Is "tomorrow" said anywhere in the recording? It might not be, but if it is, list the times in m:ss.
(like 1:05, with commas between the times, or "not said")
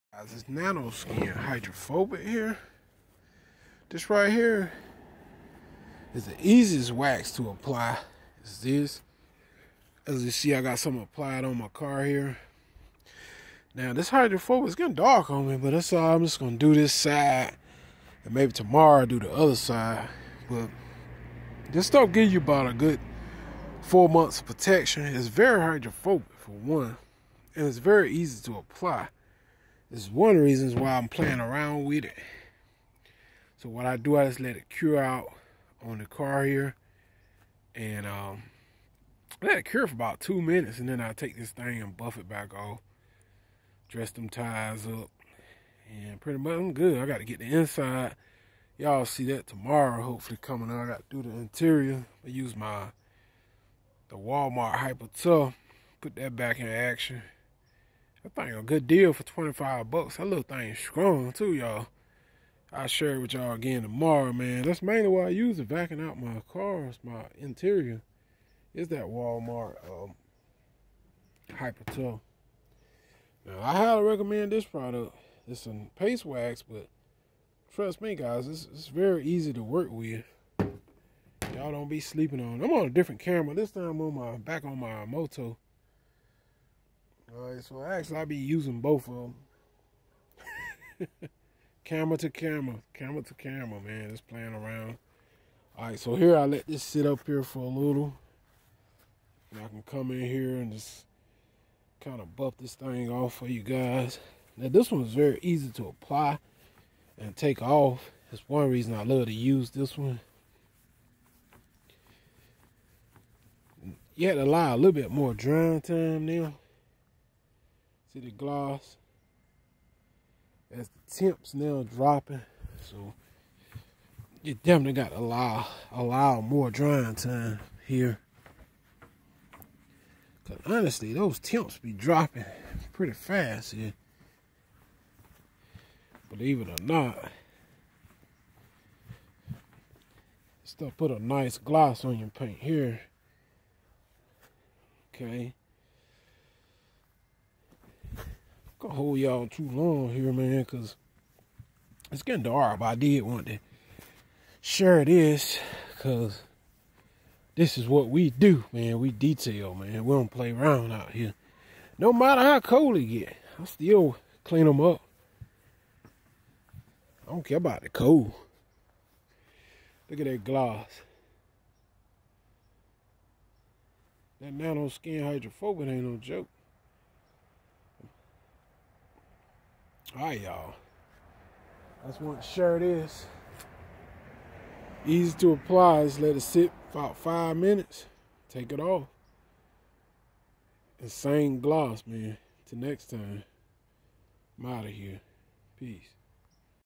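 0:18, 0:49, 1:03.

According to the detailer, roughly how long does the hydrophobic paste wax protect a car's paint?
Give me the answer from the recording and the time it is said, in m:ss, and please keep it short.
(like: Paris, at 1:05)
4 months, at 0:23.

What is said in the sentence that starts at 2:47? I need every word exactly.
I don't care about the cold.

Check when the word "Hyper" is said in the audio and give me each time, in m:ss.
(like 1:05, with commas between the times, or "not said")
0:54, 1:11.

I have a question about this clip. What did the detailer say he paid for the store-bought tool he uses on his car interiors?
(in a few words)
$25.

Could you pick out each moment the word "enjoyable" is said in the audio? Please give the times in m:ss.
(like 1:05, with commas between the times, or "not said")
not said.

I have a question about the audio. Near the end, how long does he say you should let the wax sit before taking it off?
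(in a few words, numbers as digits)
5 minutes.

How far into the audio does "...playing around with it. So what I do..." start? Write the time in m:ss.
0:31.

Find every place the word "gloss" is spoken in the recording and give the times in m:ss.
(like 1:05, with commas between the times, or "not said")
1:58, 2:21, 2:50, 3:11.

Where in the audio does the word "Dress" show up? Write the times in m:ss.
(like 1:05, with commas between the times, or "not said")
0:43.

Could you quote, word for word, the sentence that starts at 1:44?
Now this one's very easy to apply and take off.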